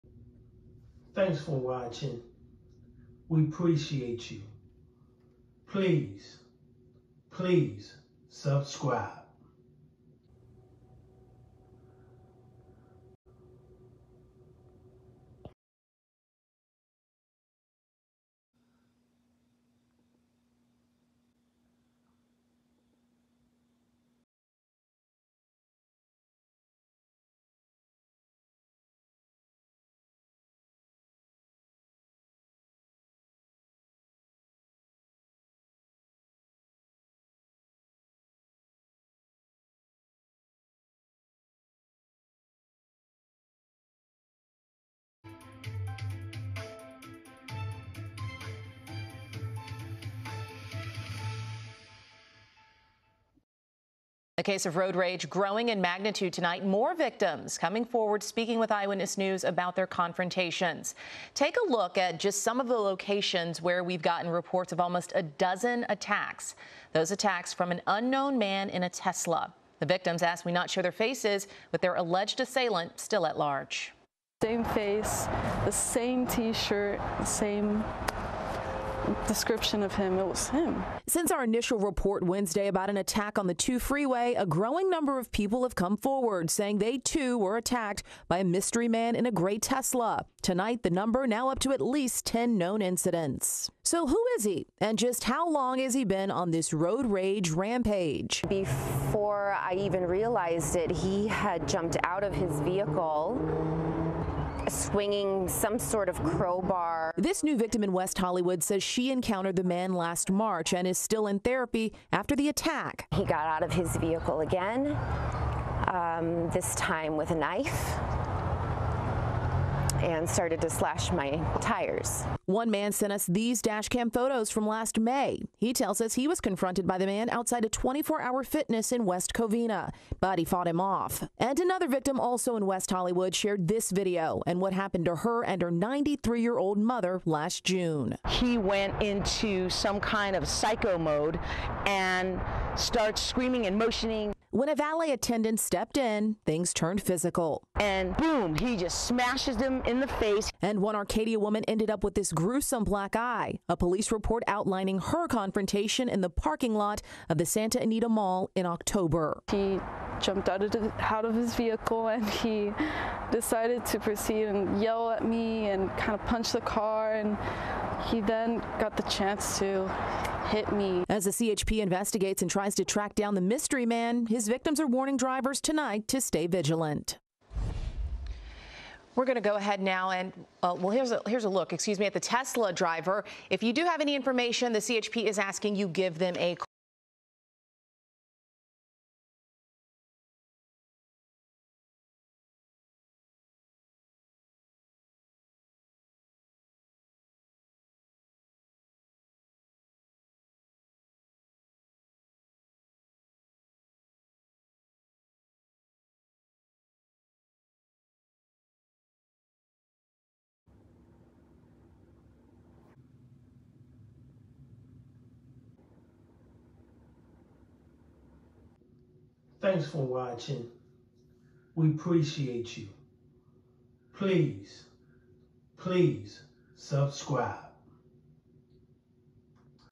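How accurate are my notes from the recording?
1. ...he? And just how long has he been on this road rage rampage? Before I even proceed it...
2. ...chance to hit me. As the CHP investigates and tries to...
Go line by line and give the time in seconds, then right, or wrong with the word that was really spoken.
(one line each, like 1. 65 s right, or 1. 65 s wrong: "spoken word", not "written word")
1. 94 s wrong: "realized", not "proceed"
2. 169 s right.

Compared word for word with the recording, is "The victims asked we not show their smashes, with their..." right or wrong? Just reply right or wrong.
wrong.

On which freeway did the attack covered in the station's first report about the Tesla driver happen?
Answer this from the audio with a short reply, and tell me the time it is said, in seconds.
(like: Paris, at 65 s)
2 freeway, at 83 s.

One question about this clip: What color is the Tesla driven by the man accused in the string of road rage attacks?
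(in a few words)
Gray.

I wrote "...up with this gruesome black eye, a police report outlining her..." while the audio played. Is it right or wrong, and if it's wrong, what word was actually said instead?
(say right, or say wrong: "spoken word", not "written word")
right.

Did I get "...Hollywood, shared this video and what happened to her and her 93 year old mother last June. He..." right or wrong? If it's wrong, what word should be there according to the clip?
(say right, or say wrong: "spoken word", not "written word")
right.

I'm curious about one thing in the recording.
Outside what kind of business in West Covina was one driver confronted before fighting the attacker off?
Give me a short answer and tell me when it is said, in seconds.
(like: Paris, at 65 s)
24 Hour Fitness, at 127 s.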